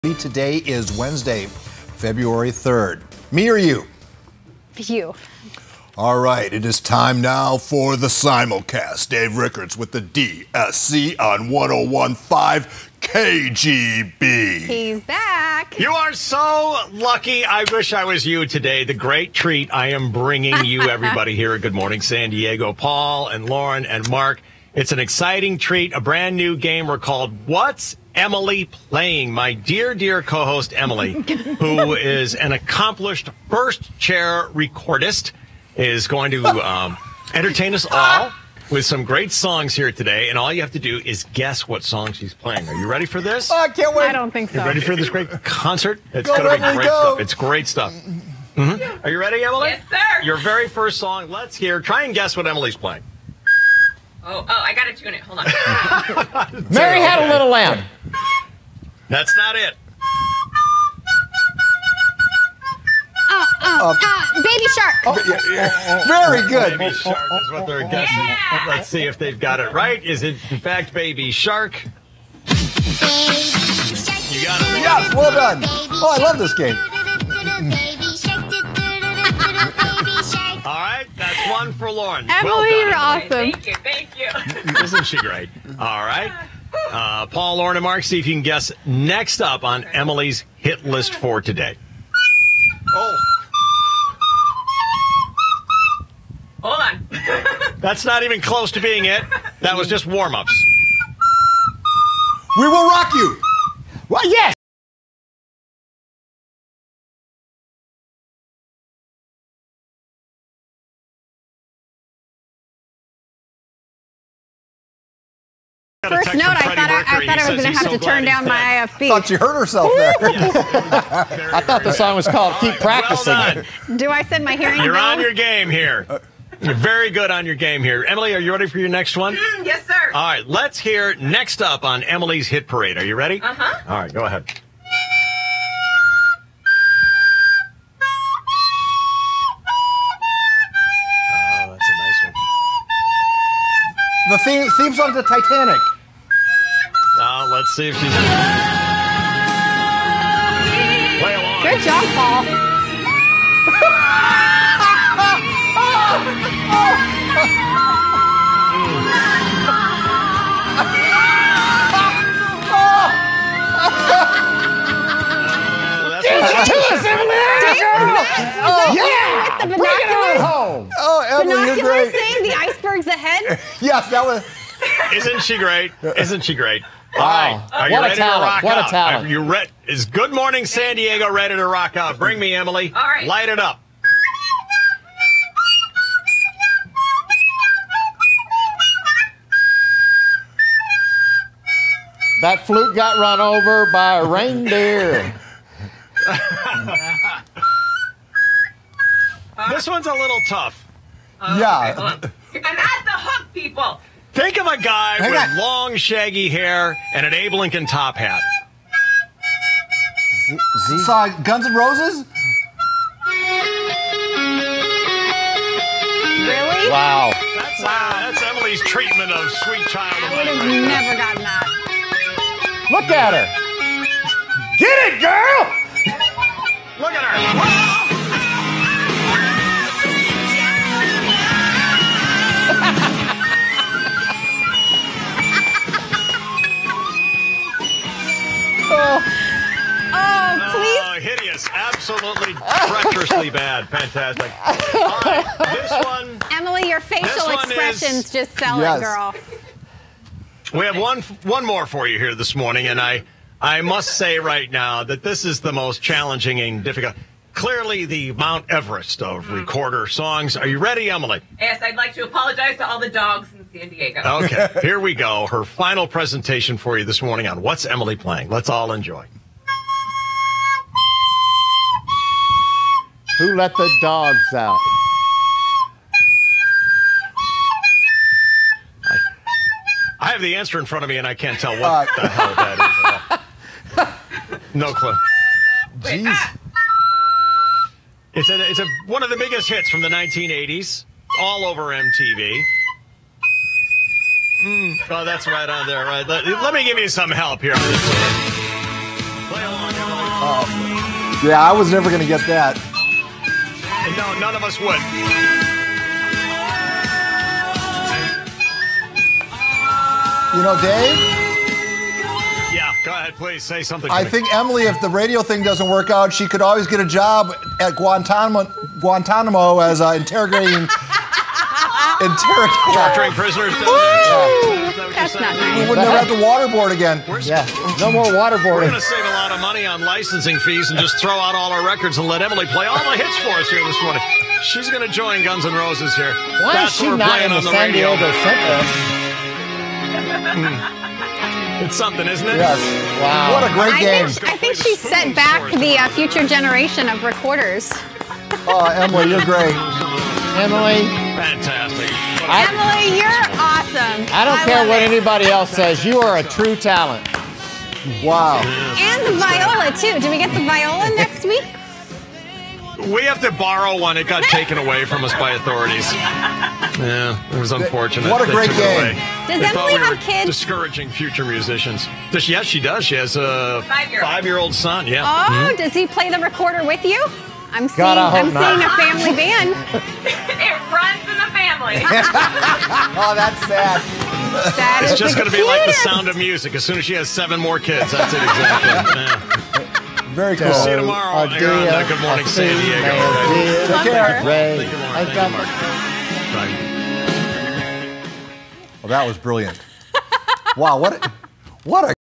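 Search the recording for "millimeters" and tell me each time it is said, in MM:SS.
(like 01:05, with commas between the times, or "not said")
not said.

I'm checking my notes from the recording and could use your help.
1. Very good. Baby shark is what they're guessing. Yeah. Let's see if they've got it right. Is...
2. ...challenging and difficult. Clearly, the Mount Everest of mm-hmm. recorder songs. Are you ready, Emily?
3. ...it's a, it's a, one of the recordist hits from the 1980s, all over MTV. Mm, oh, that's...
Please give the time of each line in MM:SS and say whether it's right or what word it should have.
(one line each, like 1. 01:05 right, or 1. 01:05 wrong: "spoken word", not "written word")
1. 01:06 right
2. 04:16 right
3. 04:48 wrong: "biggest", not "recordist".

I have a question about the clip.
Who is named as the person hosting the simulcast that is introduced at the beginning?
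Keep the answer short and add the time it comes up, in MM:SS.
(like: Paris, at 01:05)
Dave Rickards, at 00:09.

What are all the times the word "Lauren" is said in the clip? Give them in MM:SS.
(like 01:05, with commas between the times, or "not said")
00:23, 01:21, 01:27.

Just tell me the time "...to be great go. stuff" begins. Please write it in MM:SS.
00:46.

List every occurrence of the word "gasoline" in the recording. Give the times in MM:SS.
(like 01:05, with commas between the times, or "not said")
not said.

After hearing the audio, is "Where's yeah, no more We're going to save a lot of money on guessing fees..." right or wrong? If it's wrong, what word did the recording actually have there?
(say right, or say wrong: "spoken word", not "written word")
wrong: "licensing", not "guessing".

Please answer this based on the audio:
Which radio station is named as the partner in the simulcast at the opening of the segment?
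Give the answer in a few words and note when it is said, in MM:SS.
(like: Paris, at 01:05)
101.5 KGB, at 00:11.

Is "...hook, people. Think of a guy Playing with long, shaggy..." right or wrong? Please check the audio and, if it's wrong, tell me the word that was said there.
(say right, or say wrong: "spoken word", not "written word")
wrong: "Hang", not "Playing".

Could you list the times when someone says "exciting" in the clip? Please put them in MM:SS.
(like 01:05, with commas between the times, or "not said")
00:24.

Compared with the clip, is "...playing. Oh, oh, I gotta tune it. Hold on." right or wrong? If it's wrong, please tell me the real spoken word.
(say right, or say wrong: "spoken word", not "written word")
right.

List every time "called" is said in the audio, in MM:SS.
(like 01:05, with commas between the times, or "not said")
00:26, 02:02.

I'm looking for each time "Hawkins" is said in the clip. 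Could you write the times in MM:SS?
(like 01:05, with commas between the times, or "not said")
not said.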